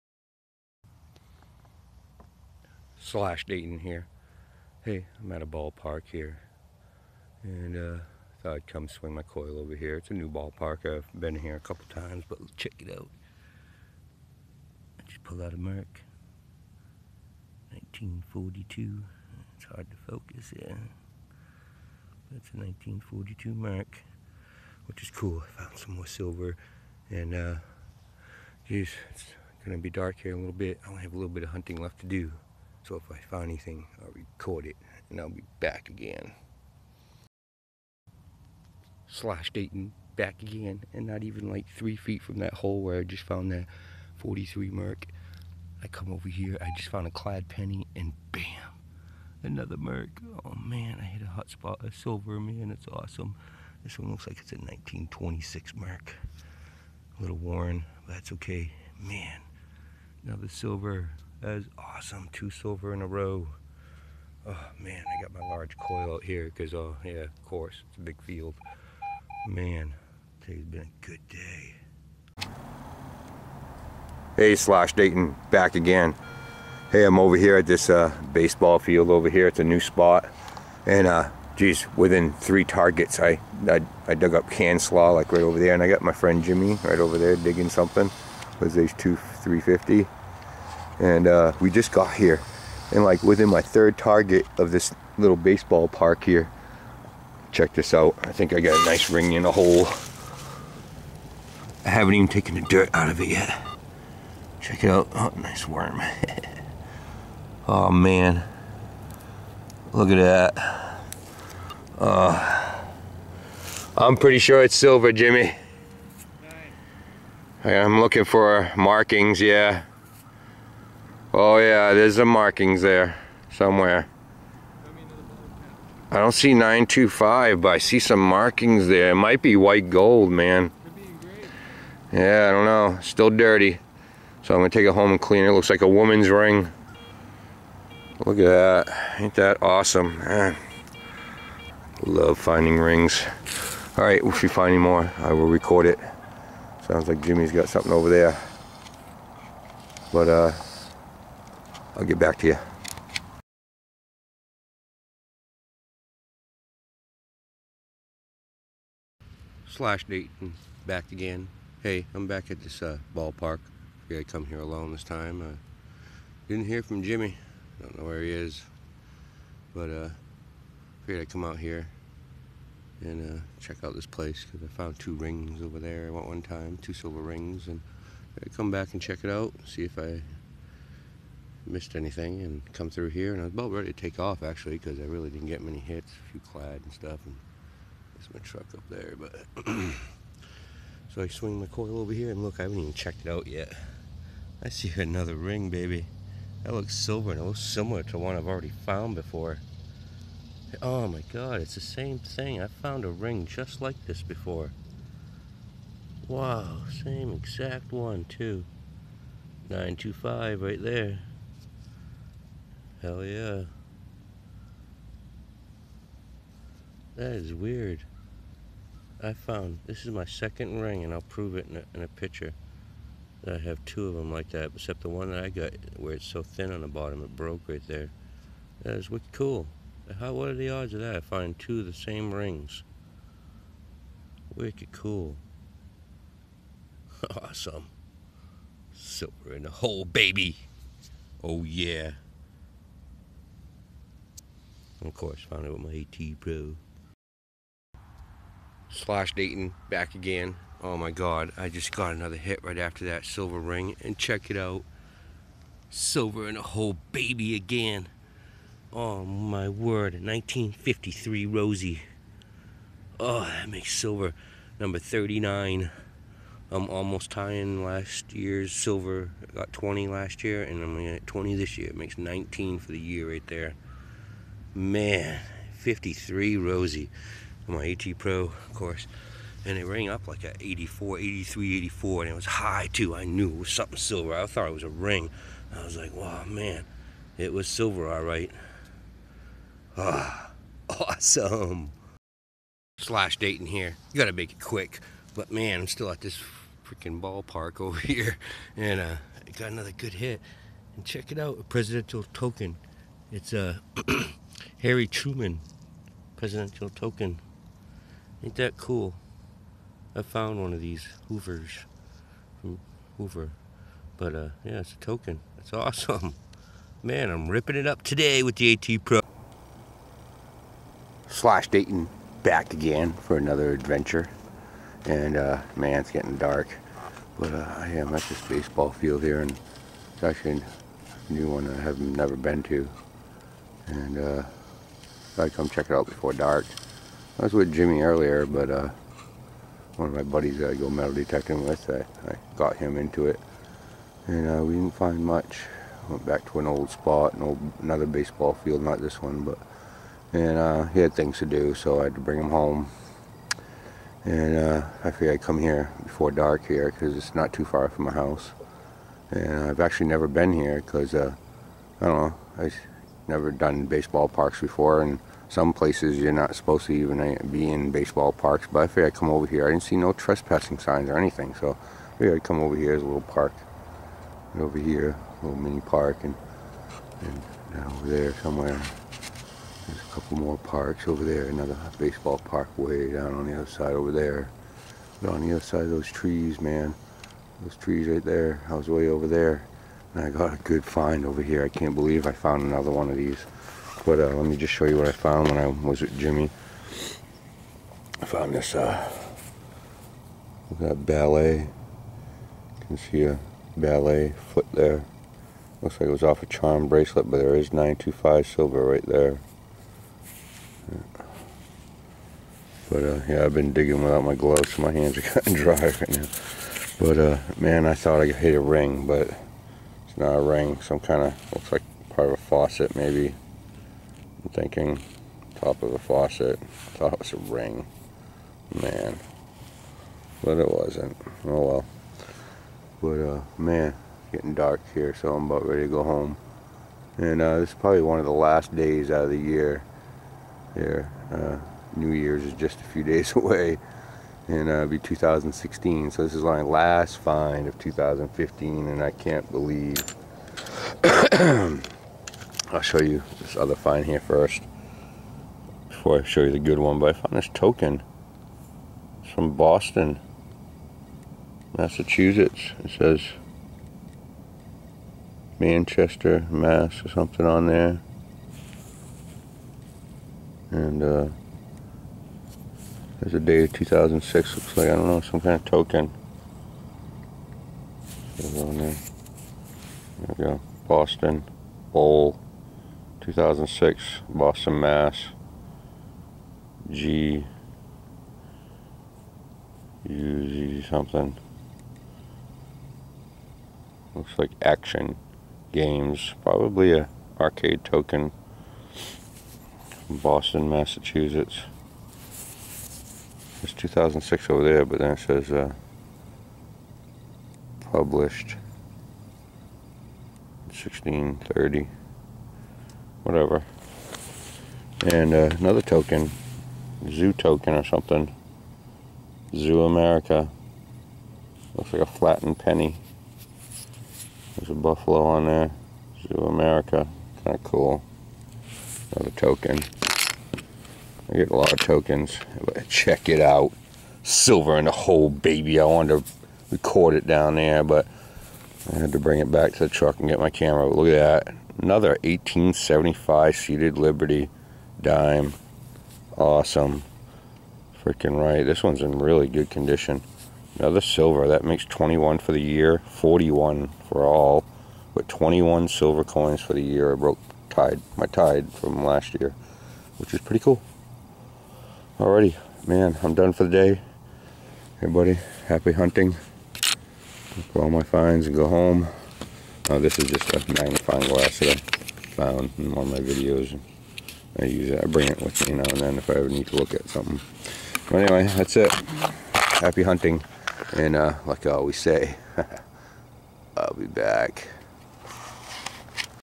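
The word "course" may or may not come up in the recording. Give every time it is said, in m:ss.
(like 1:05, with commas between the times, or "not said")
1:07, 4:05, 4:38.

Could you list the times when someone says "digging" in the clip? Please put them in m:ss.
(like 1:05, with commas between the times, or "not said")
1:27, 6:53.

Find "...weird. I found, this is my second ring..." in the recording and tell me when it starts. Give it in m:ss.
3:37.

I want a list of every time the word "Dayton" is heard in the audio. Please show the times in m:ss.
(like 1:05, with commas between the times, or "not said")
0:03, 0:39, 1:14, 2:40, 4:09, 4:53, 5:21.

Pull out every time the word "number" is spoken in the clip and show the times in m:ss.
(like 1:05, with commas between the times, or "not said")
4:24.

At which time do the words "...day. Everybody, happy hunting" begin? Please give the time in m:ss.
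9:23.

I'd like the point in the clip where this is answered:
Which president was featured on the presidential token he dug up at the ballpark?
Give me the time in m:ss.
5:04.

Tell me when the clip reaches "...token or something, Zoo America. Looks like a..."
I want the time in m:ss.
8:37.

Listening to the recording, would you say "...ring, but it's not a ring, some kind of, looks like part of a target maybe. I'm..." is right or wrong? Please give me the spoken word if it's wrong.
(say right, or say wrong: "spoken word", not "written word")
wrong: "faucet", not "target".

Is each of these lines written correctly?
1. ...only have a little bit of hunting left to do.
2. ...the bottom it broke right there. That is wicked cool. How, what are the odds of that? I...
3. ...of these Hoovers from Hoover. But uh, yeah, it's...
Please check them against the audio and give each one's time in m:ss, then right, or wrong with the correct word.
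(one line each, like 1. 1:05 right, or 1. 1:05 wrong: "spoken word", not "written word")
1. 0:30 right
2. 3:46 right
3. 5:10 right.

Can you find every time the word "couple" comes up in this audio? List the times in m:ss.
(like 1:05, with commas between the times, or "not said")
0:11, 6:20.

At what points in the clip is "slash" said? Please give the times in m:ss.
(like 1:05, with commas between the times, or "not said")
0:03, 0:39, 1:14, 2:39, 4:08, 4:52, 5:21.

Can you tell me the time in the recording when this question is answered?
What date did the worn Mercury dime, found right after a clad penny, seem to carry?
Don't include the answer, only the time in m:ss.
0:54.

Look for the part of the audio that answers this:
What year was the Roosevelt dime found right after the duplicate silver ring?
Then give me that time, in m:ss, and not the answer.
4:20.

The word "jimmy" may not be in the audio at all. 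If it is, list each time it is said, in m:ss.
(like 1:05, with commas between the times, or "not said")
1:26, 1:55, 2:27, 2:47, 5:37, 6:36.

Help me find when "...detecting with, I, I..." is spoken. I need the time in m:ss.
5:41.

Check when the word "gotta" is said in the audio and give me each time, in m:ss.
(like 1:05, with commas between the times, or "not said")
4:54.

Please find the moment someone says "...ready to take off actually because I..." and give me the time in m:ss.
3:03.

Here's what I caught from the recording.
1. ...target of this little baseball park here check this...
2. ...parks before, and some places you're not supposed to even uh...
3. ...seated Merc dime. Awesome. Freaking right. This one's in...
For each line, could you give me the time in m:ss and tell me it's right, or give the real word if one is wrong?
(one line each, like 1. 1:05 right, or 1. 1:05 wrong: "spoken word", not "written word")
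1. 1:33 right
2. 6:04 right
3. 9:03 wrong: "Liberty", not "Merc".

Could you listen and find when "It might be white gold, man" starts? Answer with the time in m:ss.
2:09.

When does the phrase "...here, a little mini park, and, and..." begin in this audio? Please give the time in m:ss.
6:14.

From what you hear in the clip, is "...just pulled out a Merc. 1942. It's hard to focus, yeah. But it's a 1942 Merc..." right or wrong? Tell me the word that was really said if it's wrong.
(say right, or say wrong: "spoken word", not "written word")
right.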